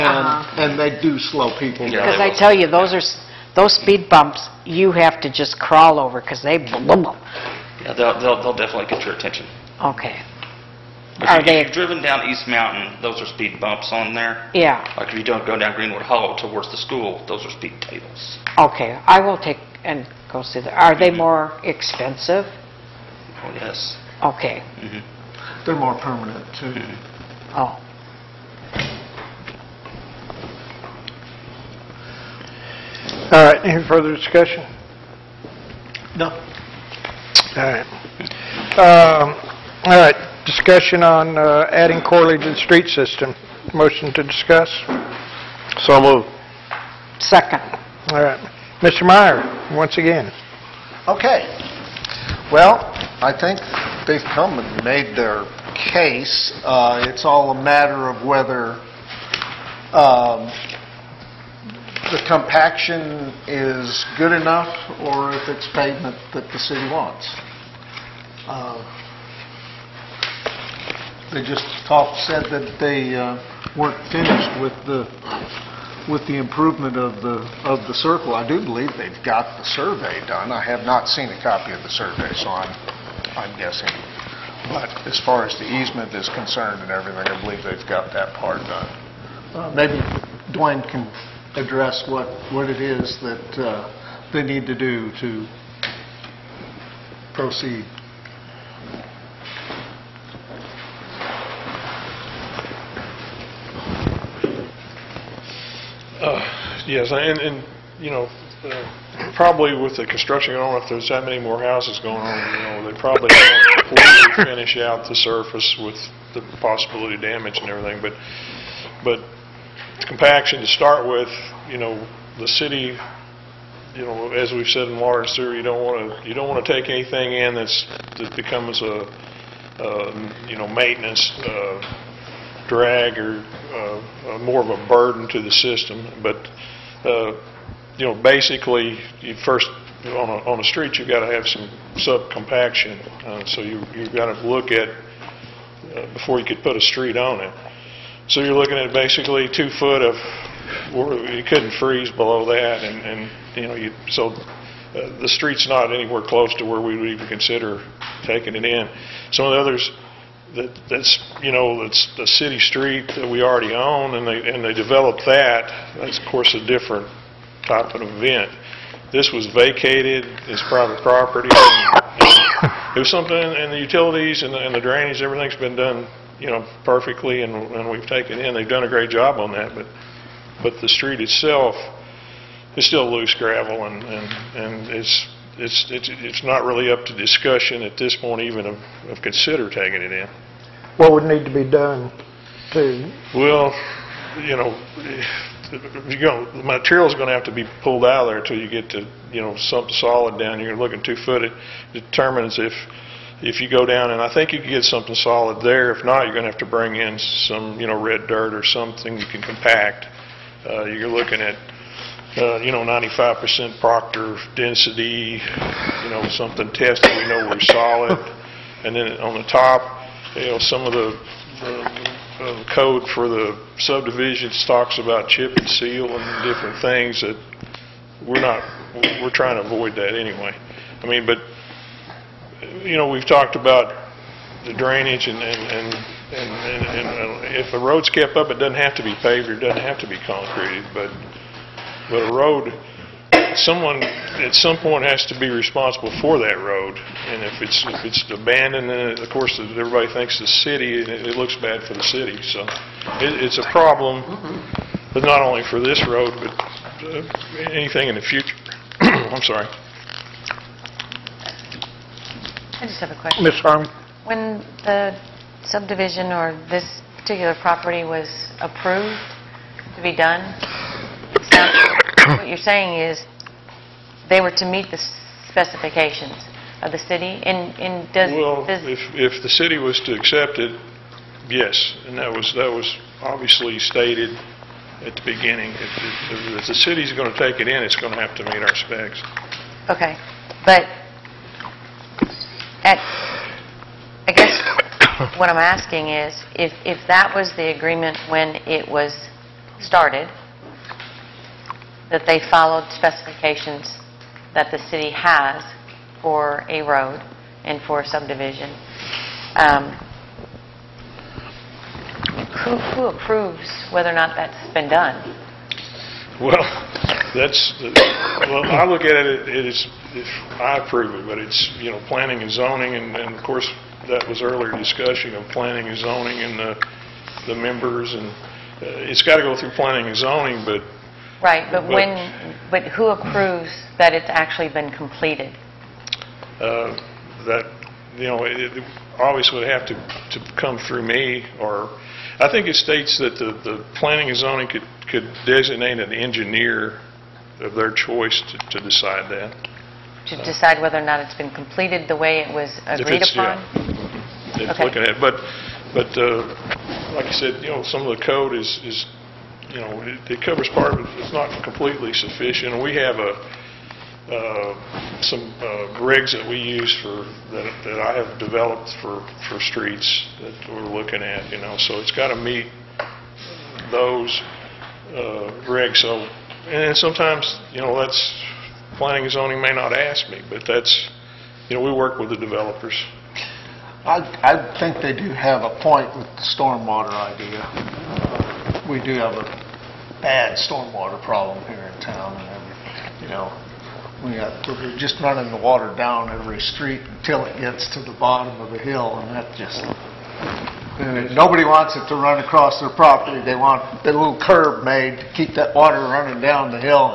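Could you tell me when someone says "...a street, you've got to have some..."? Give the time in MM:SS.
02:20.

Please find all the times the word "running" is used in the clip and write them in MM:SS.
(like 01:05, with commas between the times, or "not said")
06:35, 06:46.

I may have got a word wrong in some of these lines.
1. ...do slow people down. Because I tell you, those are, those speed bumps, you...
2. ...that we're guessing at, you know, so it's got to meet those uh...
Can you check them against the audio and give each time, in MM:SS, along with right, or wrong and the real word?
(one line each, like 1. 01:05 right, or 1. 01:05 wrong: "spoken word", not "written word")
1. 00:01 right
2. 06:10 wrong: "looking", not "guessing".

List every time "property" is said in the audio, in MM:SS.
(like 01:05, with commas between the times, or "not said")
02:51, 04:27, 06:42.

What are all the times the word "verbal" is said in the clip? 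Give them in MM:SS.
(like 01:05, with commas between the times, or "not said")
not said.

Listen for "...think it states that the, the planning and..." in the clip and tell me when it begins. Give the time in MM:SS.
05:42.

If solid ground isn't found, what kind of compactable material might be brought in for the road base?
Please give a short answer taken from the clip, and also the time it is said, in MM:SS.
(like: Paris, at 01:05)
red dirt, at 03:27.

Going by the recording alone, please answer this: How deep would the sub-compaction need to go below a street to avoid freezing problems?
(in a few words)
2 feet.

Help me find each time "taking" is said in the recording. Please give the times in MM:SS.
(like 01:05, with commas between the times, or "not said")
02:38, 03:09.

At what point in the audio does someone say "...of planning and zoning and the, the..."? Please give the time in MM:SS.
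05:25.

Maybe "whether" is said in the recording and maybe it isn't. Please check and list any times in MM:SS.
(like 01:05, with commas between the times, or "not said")
00:58, 05:13, 05:50.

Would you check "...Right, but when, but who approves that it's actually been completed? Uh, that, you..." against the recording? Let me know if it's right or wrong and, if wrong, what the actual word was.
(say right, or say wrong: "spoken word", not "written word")
right.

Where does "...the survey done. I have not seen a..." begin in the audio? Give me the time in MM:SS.
01:19.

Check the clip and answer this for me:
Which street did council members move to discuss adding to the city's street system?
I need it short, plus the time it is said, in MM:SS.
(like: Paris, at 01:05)
Corley, at 00:42.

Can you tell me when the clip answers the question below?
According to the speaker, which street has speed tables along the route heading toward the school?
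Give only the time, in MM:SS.
00:15.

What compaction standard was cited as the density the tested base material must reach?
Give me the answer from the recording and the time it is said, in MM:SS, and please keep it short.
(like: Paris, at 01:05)
95% proctor density, at 03:32.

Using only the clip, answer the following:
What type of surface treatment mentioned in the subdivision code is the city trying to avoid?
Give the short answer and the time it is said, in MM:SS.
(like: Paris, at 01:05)
chip and seal, at 03:45.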